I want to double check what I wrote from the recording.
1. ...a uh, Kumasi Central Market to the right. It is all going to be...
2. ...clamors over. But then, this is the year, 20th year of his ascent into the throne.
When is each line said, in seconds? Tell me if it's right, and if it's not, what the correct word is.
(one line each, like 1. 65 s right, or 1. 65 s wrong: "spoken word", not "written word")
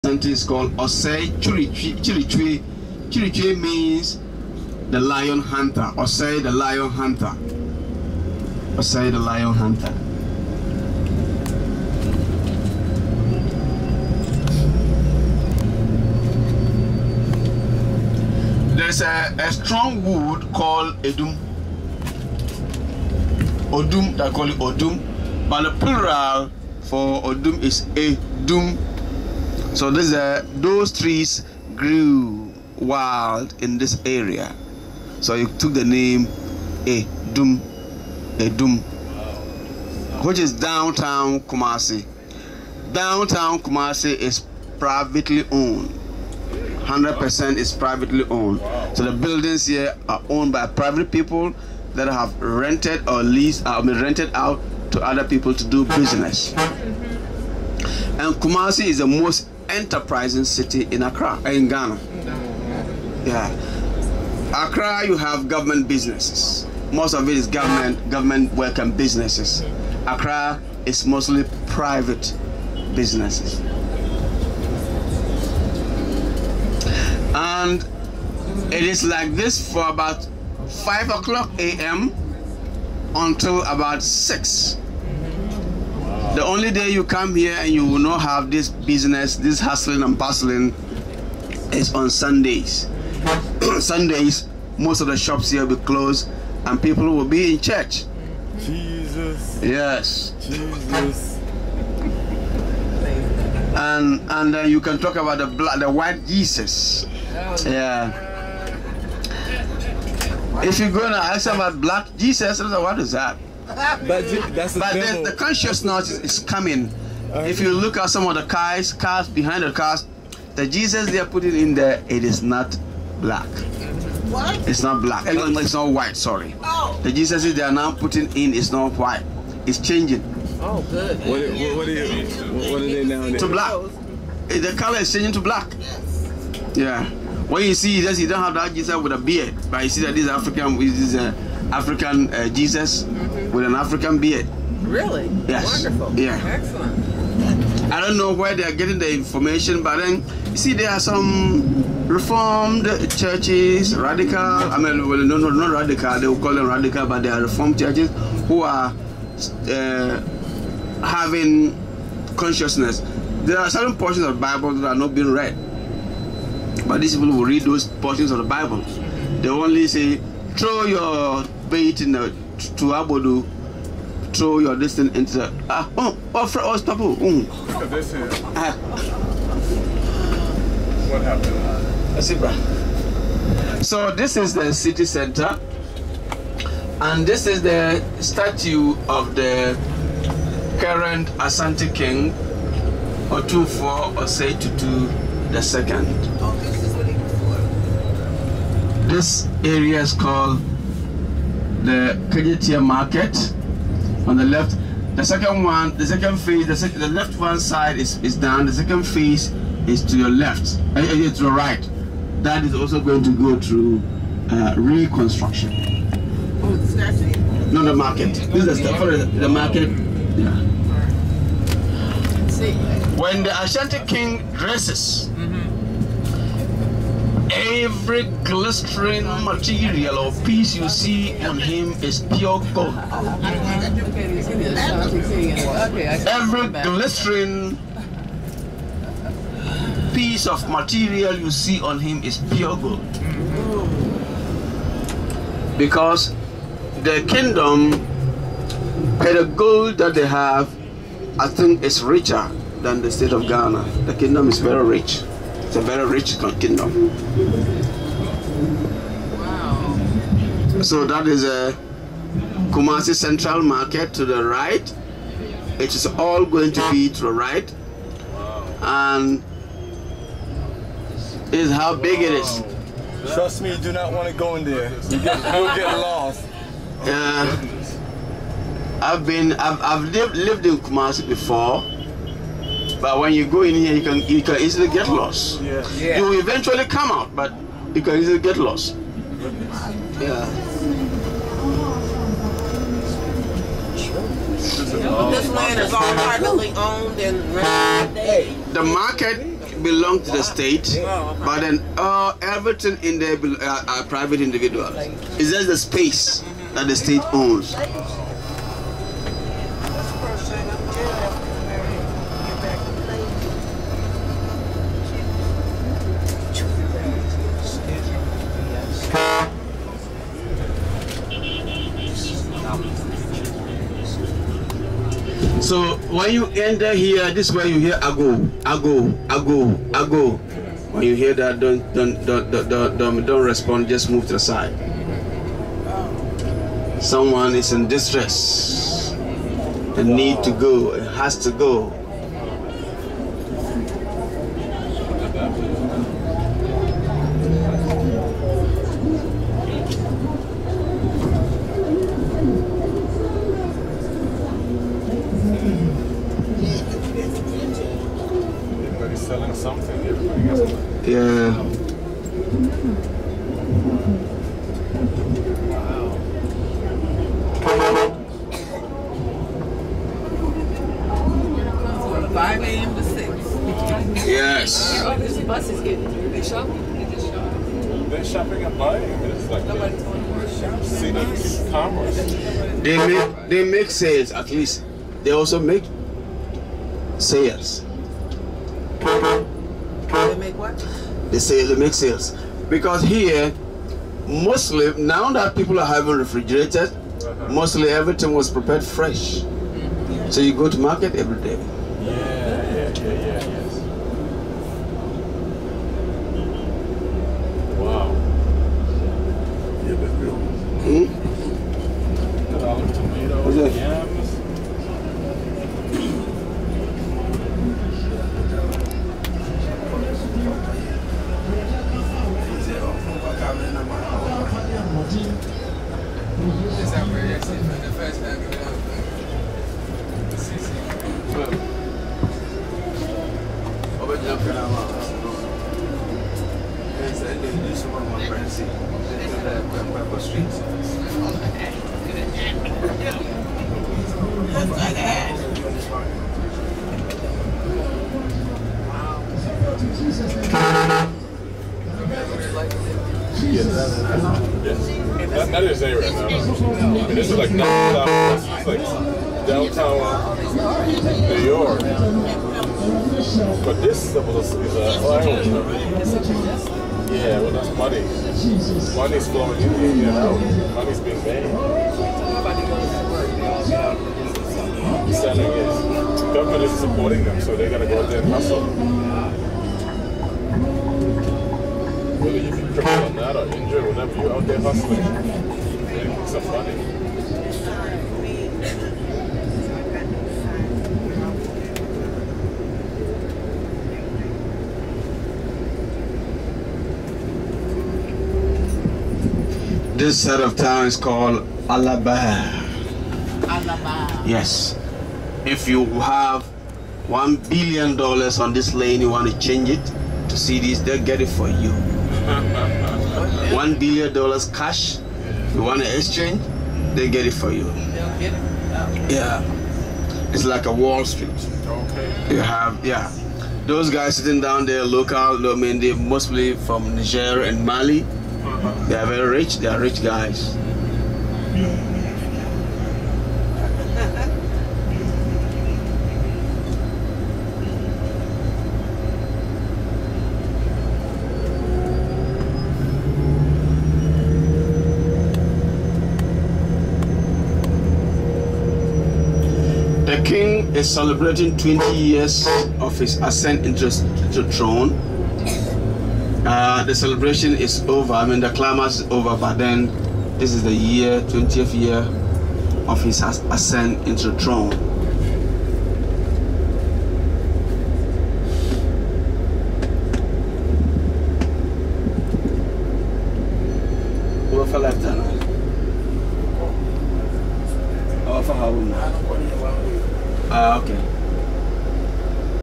1. 261 s right
2. 558 s right.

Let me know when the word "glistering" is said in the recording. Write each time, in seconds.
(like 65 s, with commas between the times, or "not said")
228 s, 236 s.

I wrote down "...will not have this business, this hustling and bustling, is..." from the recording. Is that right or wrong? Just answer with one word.
right.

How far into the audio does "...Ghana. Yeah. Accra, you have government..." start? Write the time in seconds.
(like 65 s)
61 s.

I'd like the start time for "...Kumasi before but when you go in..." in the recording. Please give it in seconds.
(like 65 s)
280 s.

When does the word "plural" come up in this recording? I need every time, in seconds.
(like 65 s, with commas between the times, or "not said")
25 s.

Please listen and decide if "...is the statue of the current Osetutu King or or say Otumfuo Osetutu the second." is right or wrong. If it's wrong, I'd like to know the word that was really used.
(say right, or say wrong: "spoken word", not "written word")
wrong: "Asante", not "Osetutu".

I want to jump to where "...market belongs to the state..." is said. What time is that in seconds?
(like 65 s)
298 s.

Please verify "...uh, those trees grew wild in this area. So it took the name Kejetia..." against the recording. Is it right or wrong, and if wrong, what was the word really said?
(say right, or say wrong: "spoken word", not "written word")
wrong: "Edum", not "Kejetia".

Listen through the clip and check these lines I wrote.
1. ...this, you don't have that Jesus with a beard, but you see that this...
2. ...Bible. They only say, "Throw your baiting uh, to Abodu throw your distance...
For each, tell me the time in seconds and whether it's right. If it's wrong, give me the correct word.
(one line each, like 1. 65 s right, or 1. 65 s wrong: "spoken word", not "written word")
1. 138 s right
2. 168 s right.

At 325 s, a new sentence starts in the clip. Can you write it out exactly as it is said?
So when you enter here, this is where you hear ago, ago, ago, ago.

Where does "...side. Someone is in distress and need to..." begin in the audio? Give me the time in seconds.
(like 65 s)
334 s.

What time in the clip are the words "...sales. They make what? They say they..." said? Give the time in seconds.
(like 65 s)
387 s.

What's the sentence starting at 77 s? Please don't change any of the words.
And it is like this for about 5 o'clock a.m.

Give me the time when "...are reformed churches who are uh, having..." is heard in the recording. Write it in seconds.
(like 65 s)
157 s.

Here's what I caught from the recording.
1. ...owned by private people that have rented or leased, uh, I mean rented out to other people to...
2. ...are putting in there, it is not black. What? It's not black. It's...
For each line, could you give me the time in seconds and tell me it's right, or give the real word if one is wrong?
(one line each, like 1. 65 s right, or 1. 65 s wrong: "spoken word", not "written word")
1. 50 s right
2. 121 s right.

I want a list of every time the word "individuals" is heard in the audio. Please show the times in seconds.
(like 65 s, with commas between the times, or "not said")
304 s.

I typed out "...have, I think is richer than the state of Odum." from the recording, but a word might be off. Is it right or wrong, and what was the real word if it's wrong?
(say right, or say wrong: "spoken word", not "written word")
wrong: "Ghana", not "Odum".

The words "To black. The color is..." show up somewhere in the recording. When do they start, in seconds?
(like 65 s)
133 s.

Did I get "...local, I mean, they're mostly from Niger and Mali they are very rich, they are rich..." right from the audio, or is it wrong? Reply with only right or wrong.
right.